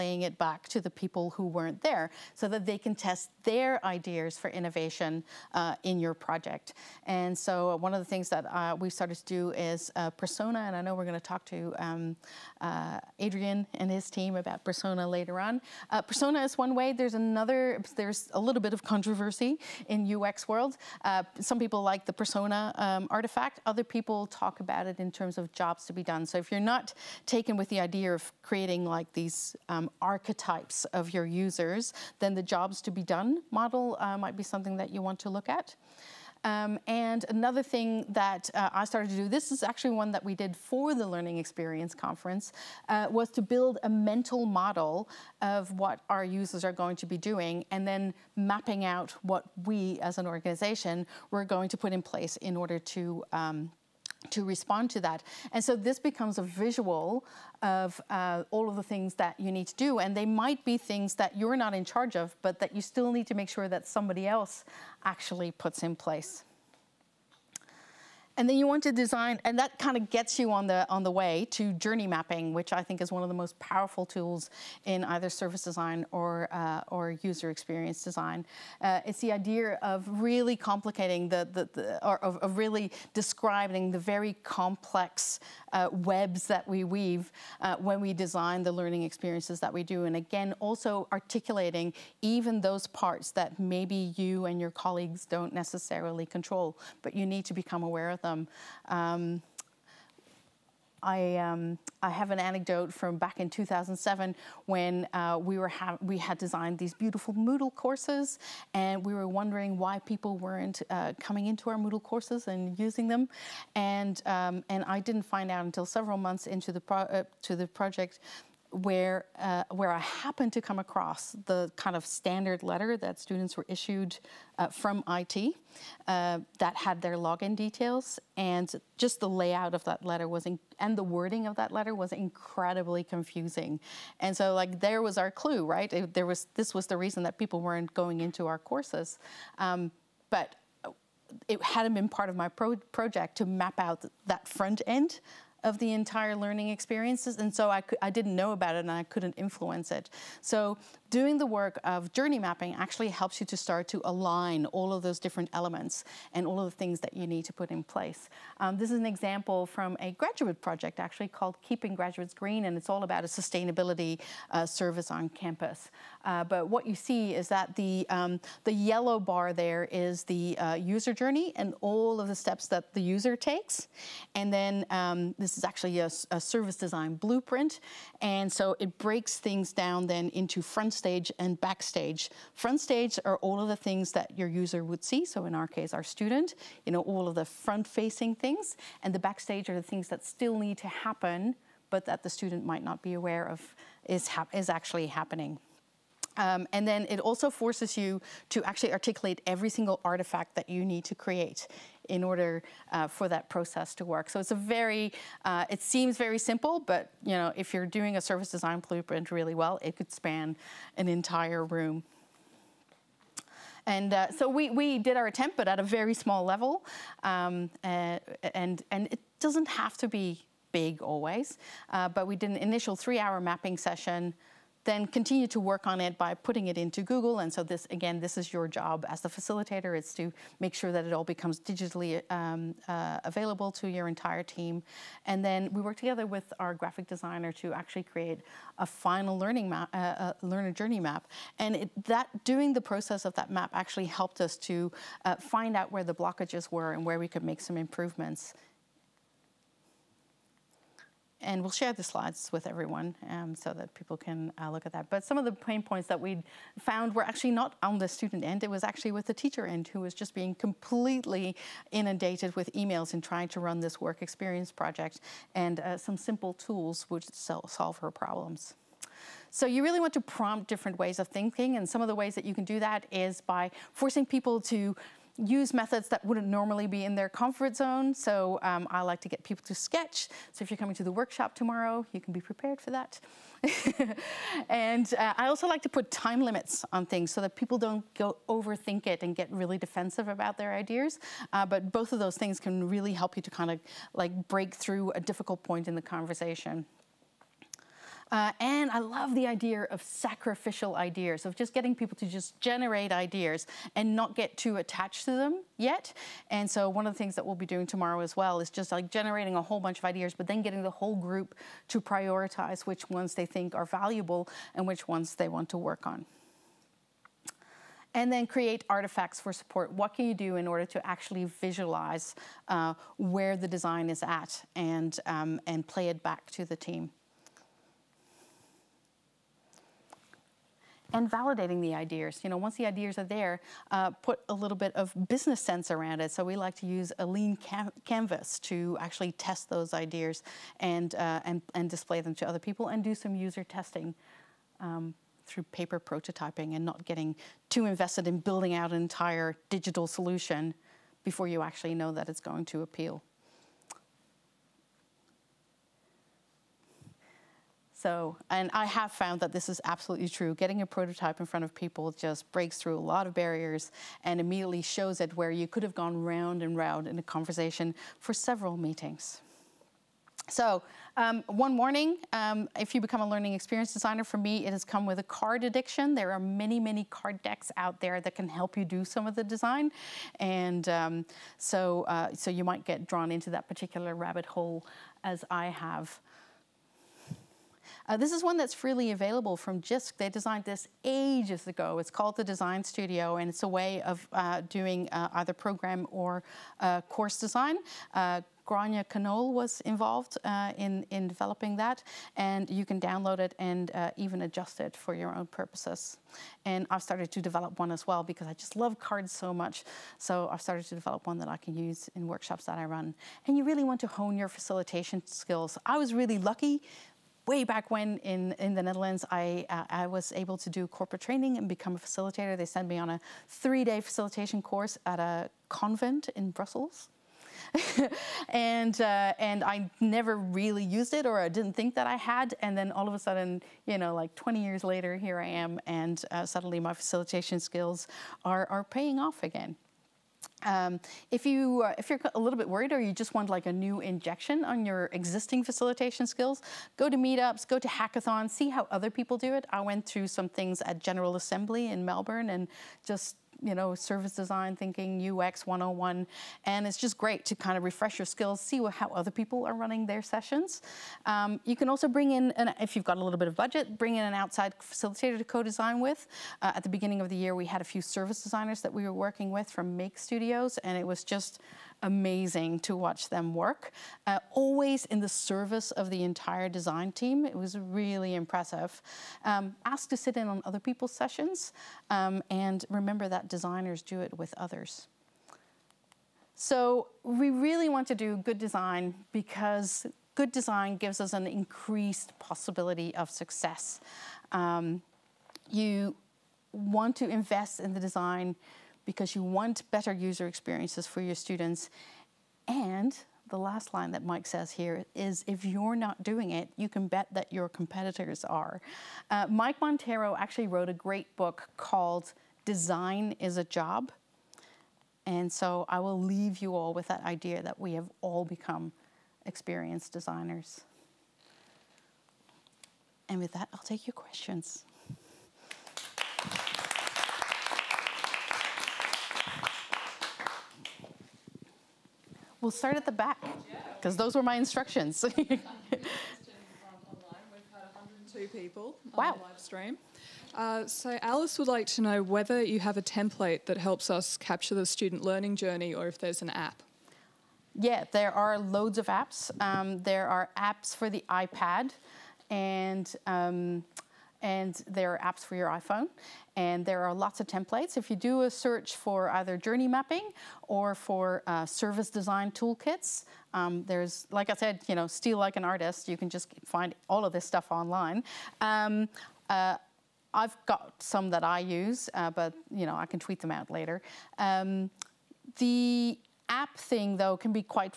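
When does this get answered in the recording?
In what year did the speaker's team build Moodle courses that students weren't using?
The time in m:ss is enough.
1:43.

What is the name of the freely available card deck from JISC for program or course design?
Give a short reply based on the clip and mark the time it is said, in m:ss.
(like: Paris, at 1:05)
The Design Studio, at 6:32.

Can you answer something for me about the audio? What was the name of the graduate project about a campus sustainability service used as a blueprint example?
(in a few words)
Keeping Graduates Green.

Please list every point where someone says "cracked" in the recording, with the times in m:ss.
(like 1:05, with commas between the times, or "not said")
not said.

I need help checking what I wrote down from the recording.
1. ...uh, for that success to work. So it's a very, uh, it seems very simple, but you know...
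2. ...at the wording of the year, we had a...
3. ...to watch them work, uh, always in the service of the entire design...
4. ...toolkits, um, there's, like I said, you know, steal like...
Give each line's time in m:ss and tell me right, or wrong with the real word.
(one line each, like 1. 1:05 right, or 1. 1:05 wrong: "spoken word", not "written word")
1. 3:22 wrong: "process", not "success"
2. 7:46 wrong: "beginning", not "wording"
3. 7:52 right
4. 9:22 right.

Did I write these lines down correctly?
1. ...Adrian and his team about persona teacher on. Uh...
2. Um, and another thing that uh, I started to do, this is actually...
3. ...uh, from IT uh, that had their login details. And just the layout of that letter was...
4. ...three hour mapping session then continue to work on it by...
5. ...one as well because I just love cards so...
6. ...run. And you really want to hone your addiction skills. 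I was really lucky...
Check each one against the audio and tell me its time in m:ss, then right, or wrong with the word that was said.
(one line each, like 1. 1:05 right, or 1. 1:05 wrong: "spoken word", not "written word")
1. 0:13 wrong: "later", not "teacher"
2. 0:36 right
3. 2:04 right
4. 3:42 right
5. 6:47 right
6. 6:52 wrong: "facilitation", not "addiction".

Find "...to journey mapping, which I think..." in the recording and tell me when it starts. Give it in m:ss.
1:11.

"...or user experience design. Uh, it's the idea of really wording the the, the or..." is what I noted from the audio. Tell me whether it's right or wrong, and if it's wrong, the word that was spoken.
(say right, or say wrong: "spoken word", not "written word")
wrong: "complicating", not "wording".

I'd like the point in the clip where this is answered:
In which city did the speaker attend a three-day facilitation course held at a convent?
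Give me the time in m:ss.
7:06.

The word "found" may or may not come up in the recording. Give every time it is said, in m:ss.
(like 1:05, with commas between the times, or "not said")
4:16, 5:59.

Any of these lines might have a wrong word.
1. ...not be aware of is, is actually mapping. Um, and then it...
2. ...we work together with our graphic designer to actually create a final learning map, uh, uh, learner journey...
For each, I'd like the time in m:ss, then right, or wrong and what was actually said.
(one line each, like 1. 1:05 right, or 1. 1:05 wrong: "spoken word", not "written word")
1. 3:12 wrong: "happening", not "mapping"
2. 3:55 right.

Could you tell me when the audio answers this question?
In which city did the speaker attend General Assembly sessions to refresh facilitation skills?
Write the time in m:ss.
7:32.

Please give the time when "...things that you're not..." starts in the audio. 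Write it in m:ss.
1:00.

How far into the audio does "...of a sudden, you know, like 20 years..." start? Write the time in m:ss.
7:13.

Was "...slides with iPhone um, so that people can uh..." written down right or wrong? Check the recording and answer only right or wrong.
wrong.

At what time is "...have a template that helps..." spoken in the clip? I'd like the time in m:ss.
9:02.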